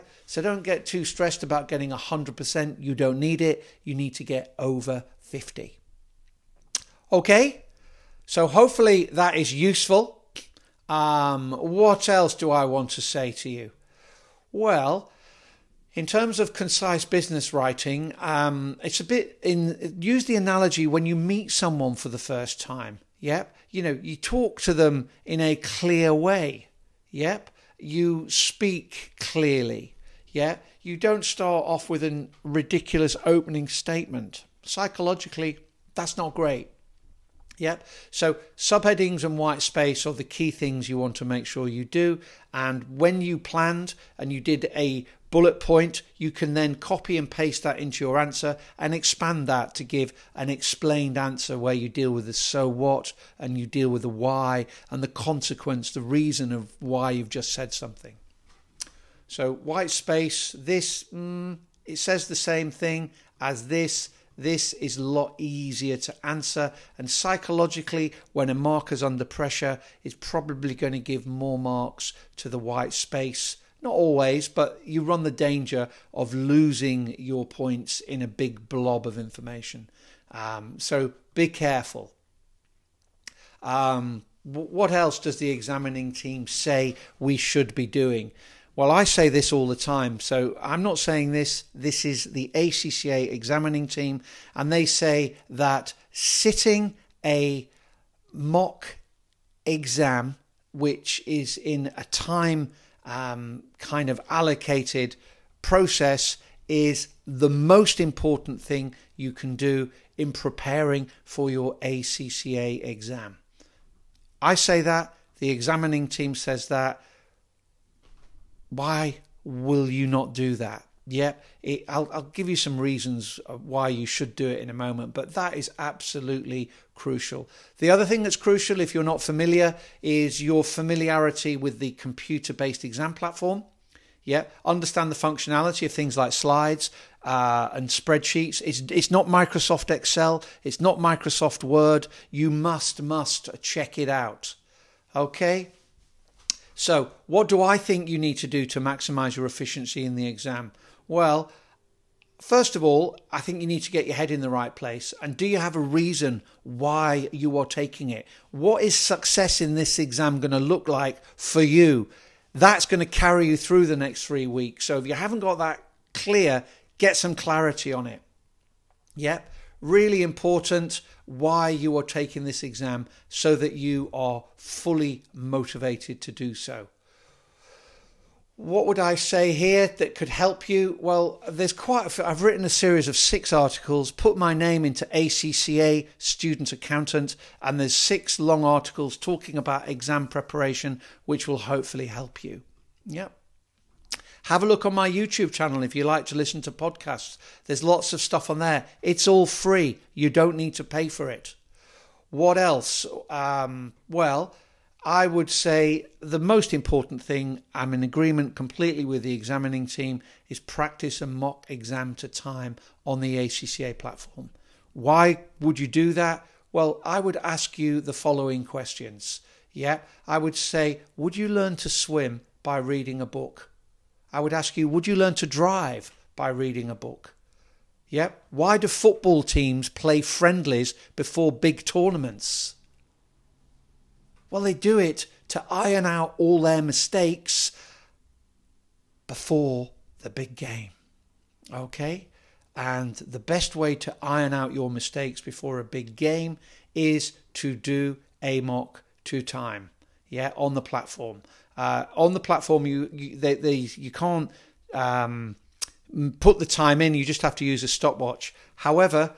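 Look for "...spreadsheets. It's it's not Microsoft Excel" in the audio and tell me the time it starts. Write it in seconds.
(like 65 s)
137 s.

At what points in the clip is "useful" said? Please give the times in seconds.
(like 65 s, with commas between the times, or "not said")
9 s.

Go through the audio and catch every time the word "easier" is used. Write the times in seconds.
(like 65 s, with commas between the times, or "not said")
65 s.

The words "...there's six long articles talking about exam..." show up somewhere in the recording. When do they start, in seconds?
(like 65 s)
187 s.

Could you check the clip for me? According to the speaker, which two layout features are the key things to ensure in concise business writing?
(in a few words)
subheadings and white space.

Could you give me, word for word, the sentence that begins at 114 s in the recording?
I say that, the examining team says that why will you not do that?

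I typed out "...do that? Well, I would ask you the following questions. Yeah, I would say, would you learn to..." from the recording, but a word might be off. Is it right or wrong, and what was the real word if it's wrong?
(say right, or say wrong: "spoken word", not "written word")
right.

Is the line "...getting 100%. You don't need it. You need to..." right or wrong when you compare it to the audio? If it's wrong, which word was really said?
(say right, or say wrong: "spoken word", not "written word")
right.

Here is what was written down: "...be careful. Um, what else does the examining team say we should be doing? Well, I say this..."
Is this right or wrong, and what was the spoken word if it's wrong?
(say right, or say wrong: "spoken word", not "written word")
right.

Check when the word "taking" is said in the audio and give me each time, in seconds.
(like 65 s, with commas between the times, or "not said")
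157 s, 172 s.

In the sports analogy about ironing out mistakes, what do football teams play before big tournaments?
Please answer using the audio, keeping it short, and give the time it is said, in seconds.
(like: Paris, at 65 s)
friendlies, at 230 s.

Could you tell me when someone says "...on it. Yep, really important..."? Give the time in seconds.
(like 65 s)
167 s.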